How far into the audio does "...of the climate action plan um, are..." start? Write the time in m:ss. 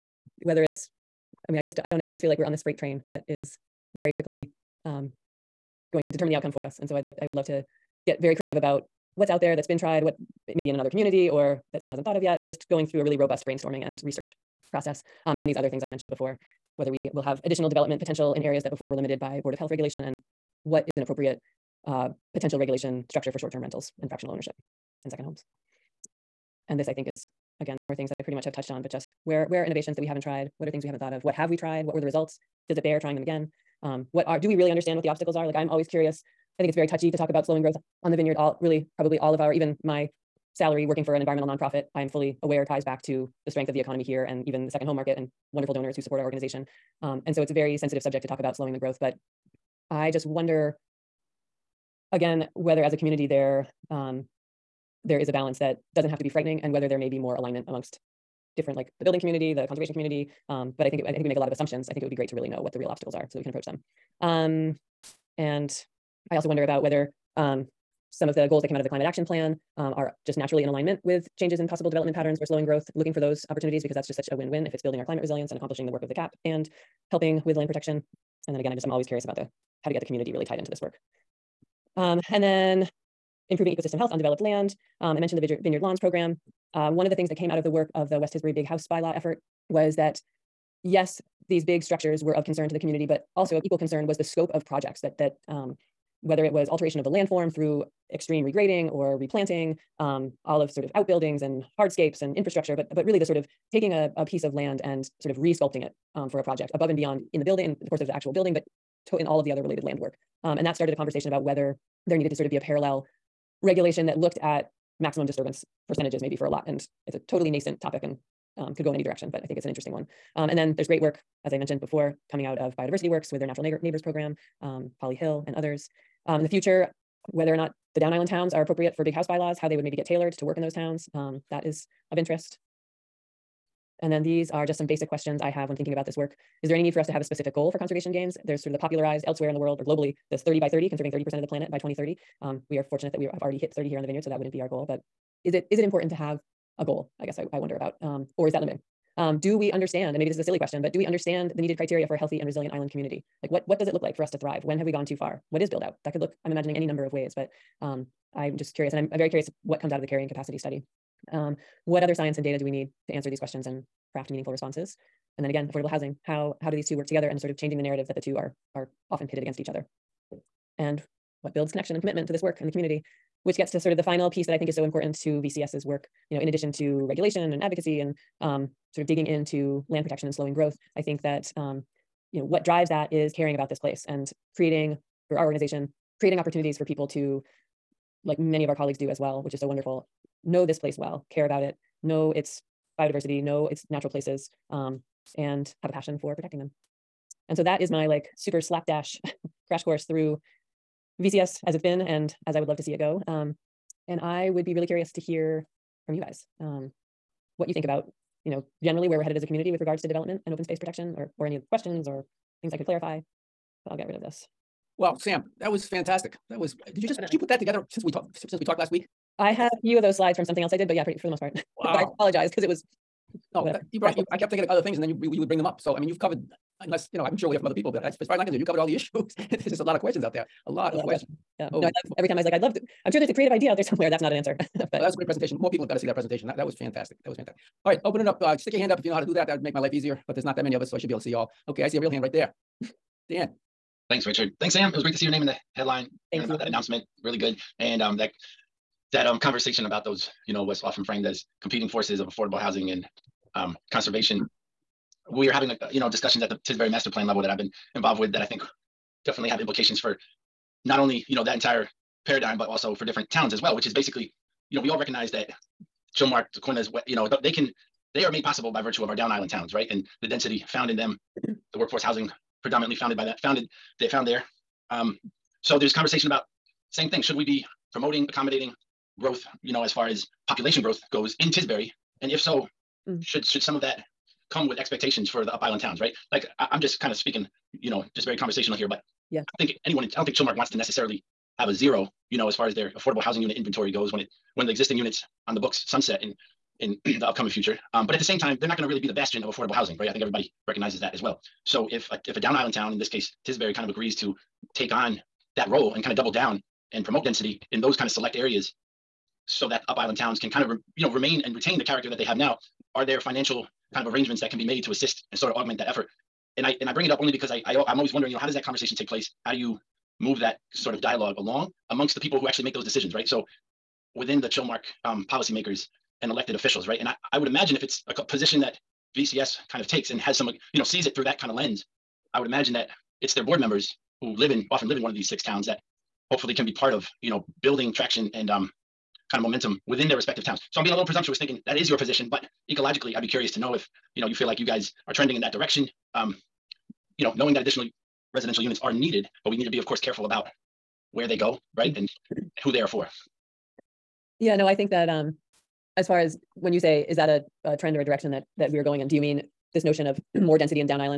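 1:08.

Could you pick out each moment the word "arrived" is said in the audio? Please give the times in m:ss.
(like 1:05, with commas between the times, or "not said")
not said.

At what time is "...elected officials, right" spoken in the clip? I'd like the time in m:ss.
5:26.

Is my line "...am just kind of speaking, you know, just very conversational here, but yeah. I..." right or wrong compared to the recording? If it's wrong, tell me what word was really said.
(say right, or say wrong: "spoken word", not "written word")
right.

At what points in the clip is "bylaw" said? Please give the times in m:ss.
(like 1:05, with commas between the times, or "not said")
1:28, 2:09.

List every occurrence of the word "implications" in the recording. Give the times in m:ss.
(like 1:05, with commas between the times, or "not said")
4:19.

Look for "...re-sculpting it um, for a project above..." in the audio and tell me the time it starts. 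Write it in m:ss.
1:45.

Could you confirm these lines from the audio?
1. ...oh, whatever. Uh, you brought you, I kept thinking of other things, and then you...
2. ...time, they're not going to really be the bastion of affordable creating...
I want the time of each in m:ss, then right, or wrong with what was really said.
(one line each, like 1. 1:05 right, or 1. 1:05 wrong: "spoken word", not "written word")
1. 3:43 right
2. 4:58 wrong: "housing", not "creating".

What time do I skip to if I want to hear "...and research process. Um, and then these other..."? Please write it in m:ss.
0:13.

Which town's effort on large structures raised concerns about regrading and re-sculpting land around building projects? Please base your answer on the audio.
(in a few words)
West Tisbury.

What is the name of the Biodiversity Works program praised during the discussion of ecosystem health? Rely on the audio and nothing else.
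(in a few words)
Natural Neighbors.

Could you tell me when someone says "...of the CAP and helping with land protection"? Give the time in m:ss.
1:16.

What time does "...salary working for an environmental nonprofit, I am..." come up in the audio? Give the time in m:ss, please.
0:40.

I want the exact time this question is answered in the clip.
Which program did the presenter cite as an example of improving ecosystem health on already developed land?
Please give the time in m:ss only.
1:25.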